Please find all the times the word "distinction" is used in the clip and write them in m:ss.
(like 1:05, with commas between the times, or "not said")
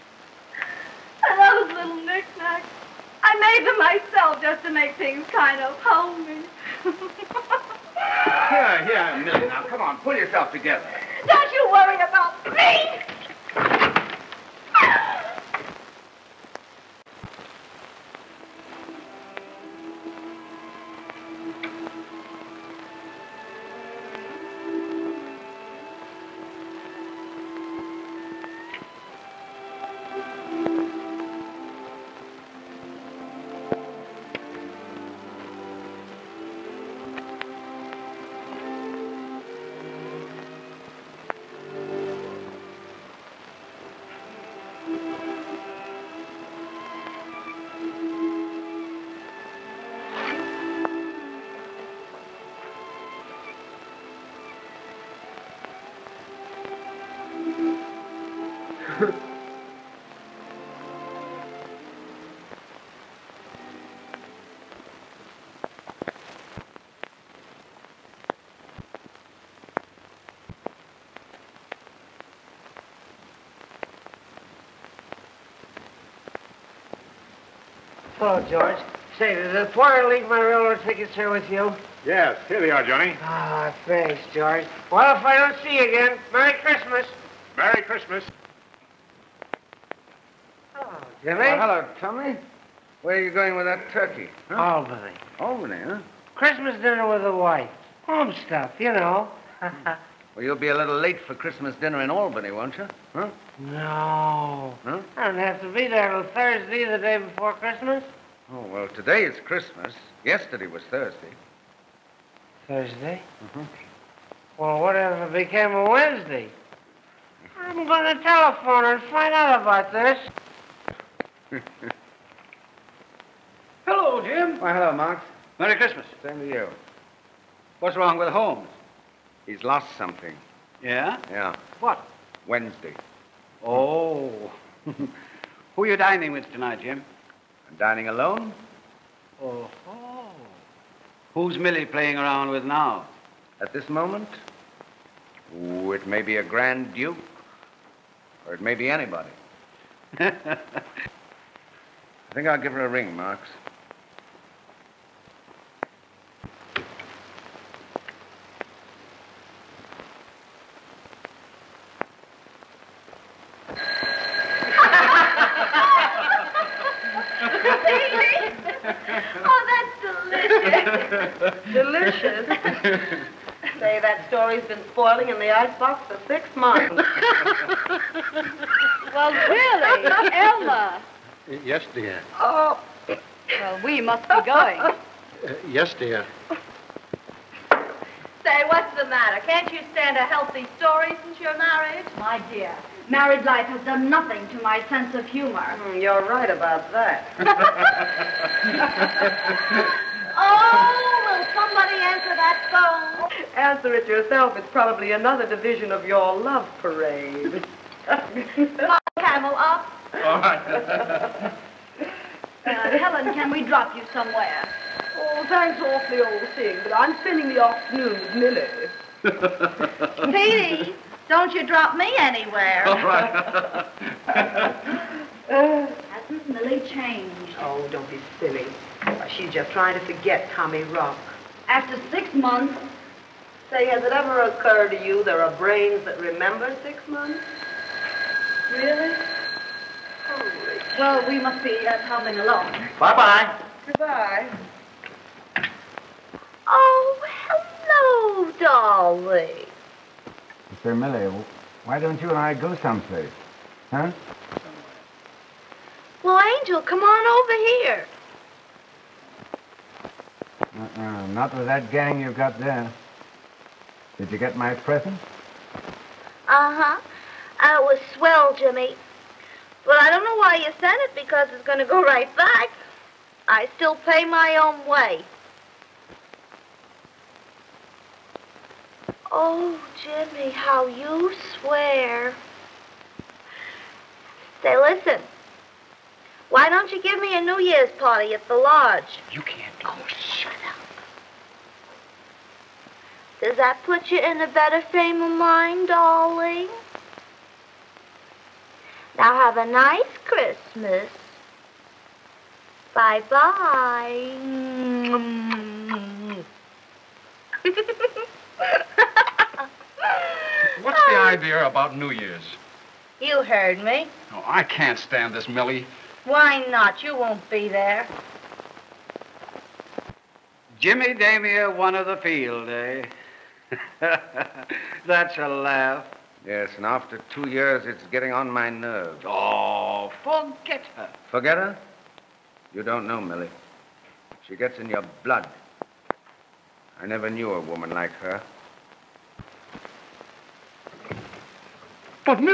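not said.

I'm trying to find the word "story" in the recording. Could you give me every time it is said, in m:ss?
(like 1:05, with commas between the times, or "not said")
2:54, 3:10.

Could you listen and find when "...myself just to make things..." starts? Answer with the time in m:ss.
0:03.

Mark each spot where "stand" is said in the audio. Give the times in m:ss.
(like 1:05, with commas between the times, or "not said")
3:09, 5:14.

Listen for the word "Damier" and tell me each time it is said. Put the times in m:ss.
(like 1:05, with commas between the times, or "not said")
5:21.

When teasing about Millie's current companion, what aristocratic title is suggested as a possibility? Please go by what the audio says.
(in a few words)
Grand Duke.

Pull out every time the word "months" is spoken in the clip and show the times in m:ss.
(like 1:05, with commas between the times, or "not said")
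2:56, 3:52, 3:57.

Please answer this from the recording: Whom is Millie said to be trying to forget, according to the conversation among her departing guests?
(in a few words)
Tommy Rock.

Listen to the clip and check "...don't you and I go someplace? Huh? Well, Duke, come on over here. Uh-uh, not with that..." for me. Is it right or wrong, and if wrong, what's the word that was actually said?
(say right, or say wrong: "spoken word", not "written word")
wrong: "Angel", not "Duke".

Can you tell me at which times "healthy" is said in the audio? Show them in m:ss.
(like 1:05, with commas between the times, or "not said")
3:10.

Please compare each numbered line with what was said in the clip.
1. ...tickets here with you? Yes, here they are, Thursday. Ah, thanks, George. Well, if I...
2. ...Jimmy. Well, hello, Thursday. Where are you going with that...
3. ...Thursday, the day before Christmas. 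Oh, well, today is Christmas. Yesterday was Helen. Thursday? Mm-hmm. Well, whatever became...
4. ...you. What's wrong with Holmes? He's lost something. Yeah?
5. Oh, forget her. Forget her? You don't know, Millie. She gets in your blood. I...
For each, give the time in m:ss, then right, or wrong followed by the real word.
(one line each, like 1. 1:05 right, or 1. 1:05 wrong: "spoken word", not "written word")
1. 1:20 wrong: "Johnny", not "Thursday"
2. 1:31 wrong: "Tommy", not "Thursday"
3. 1:46 wrong: "Thursday", not "Helen"
4. 2:06 right
5. 5:29 right.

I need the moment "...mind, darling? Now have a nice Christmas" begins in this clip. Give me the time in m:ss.
4:55.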